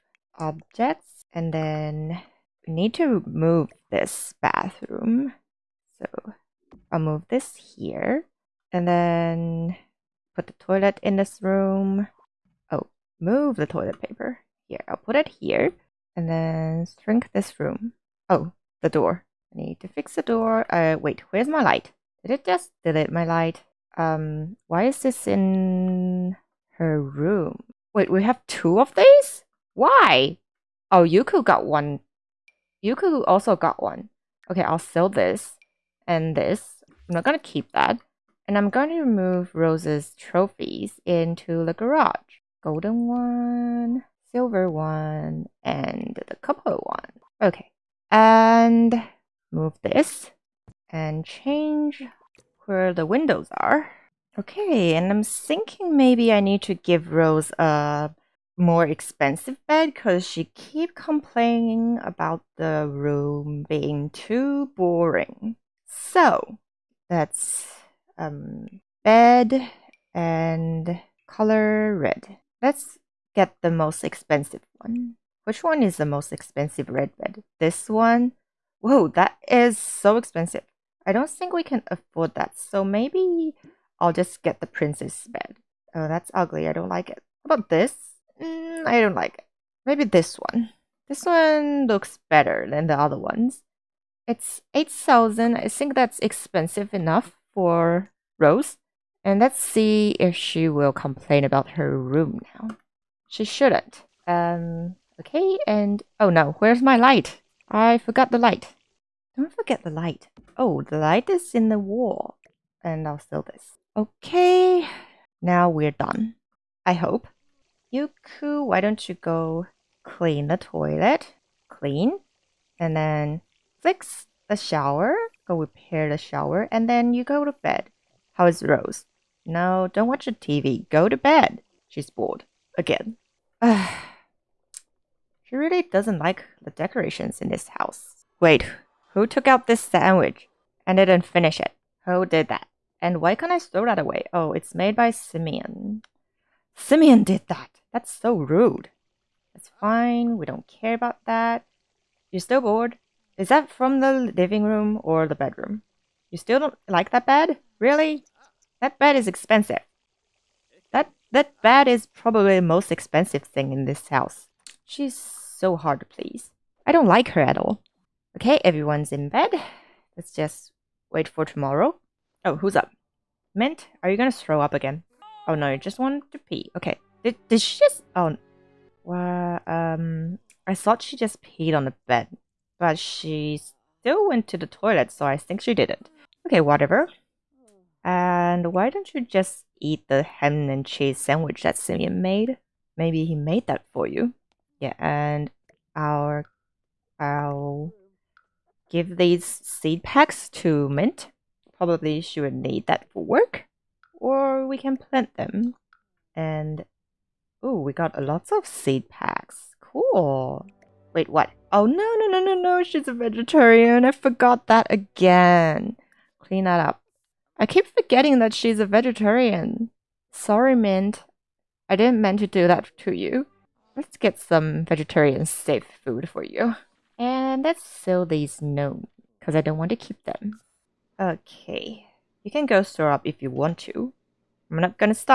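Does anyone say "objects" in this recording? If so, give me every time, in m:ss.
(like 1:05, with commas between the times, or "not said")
0:00.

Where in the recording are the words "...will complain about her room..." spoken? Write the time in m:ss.
1:40.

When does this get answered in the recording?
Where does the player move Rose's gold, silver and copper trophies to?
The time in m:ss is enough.
0:41.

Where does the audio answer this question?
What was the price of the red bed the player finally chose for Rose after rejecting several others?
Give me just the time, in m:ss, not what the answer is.
1:34.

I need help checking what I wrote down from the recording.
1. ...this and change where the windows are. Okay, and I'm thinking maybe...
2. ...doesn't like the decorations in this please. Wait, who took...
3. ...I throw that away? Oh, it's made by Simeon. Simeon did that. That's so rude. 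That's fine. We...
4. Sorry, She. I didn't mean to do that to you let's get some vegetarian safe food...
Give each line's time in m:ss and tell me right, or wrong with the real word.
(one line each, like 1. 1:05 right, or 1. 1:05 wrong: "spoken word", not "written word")
1. 0:49 right
2. 2:15 wrong: "house", not "please"
3. 2:23 right
4. 3:40 wrong: "Mint", not "She".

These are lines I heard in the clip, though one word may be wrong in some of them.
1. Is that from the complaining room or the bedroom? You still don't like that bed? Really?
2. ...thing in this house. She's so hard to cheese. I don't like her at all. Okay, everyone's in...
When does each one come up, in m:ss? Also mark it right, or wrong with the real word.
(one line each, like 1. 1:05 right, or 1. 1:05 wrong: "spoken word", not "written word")
1. 2:33 wrong: "living", not "complaining"
2. 2:43 wrong: "please", not "cheese".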